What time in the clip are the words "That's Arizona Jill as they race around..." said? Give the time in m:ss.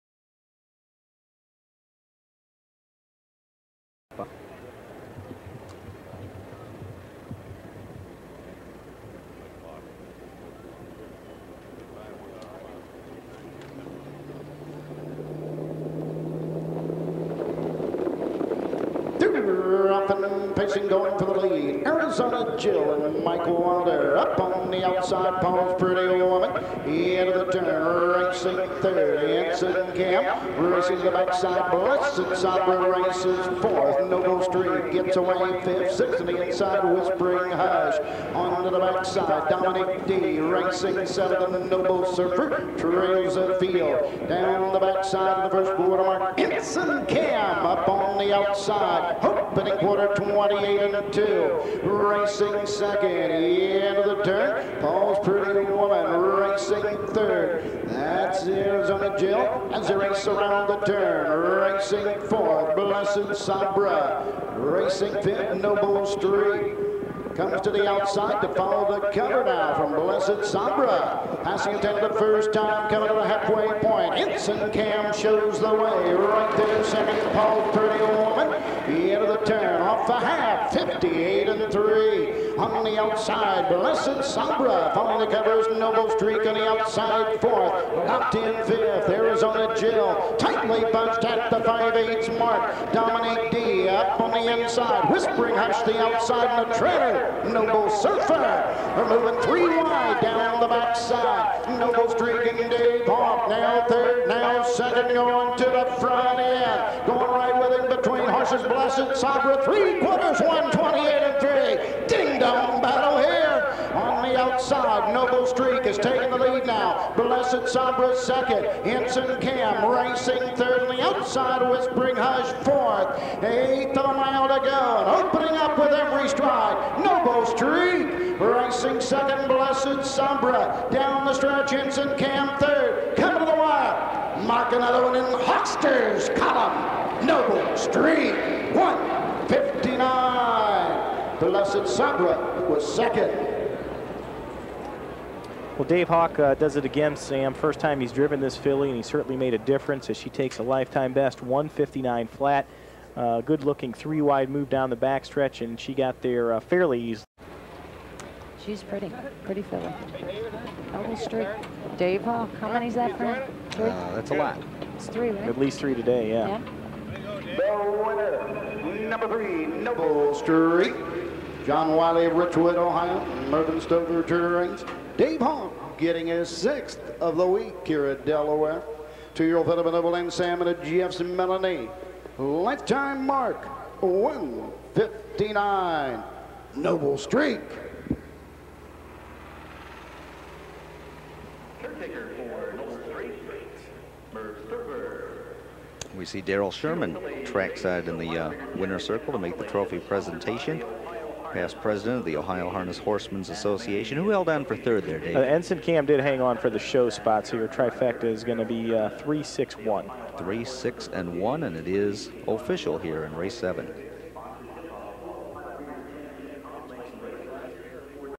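0:57.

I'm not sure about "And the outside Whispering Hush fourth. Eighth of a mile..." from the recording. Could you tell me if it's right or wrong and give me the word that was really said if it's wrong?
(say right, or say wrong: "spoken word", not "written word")
right.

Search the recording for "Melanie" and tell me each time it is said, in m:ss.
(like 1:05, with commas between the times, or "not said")
3:01.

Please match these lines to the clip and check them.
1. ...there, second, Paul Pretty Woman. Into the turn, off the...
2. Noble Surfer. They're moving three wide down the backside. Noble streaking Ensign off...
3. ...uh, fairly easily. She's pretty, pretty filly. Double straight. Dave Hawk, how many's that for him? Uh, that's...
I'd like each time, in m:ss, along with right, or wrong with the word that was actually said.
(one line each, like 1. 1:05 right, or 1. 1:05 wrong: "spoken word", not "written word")
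1. 1:16 right
2. 1:37 wrong: "Dave", not "Ensign"
3. 2:36 right.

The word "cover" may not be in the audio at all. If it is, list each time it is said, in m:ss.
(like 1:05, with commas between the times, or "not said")
1:09, 1:25.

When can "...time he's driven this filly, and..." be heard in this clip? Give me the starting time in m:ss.
2:27.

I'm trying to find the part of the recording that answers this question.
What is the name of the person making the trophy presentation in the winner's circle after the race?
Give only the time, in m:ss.
3:16.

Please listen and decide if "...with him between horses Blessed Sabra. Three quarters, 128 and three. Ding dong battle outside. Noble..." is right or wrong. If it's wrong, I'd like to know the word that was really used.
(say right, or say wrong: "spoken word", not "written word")
right.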